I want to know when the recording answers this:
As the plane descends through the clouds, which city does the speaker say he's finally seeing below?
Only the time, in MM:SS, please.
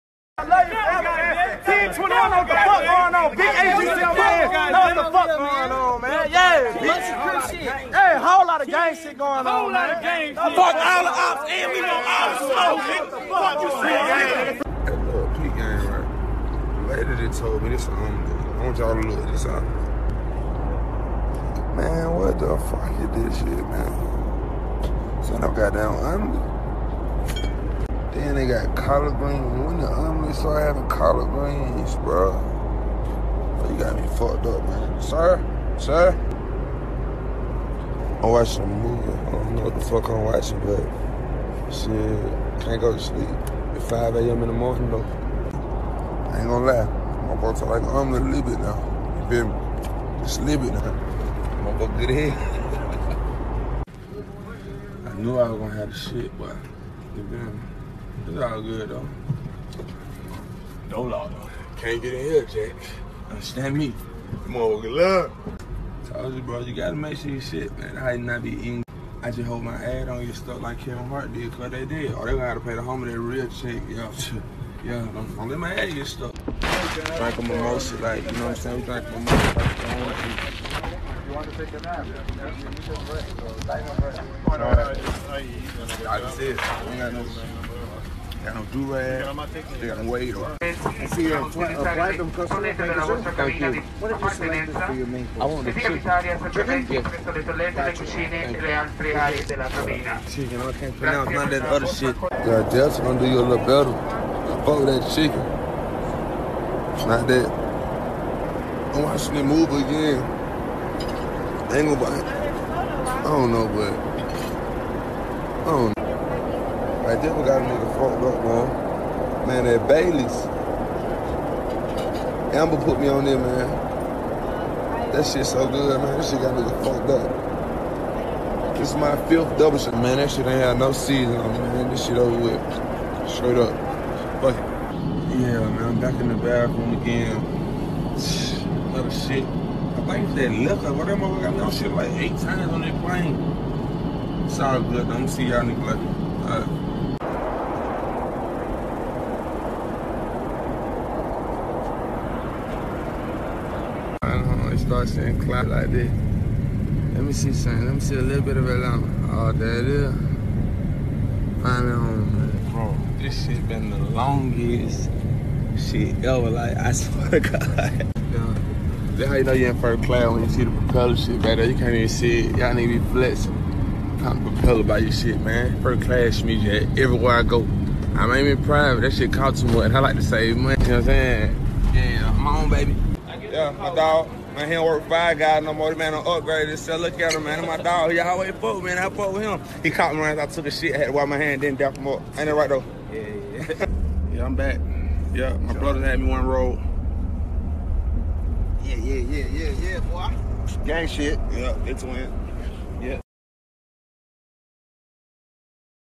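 02:38.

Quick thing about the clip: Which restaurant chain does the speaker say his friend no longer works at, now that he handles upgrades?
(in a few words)
Five Guys.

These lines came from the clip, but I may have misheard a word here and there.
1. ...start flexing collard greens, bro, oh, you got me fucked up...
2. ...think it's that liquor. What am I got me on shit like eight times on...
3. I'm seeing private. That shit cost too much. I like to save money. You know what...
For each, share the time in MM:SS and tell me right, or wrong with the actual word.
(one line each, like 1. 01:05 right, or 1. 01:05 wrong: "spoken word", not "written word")
1. 00:30 wrong: "having", not "flexing"
2. 02:20 right
3. 02:58 wrong: "aiming", not "seeing".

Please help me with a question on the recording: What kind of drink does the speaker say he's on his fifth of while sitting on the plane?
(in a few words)
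Double shot.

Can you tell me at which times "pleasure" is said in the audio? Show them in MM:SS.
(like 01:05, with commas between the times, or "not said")
not said.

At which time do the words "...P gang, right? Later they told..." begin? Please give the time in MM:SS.
00:15.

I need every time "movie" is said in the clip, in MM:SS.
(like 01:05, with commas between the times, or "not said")
00:38, 01:49.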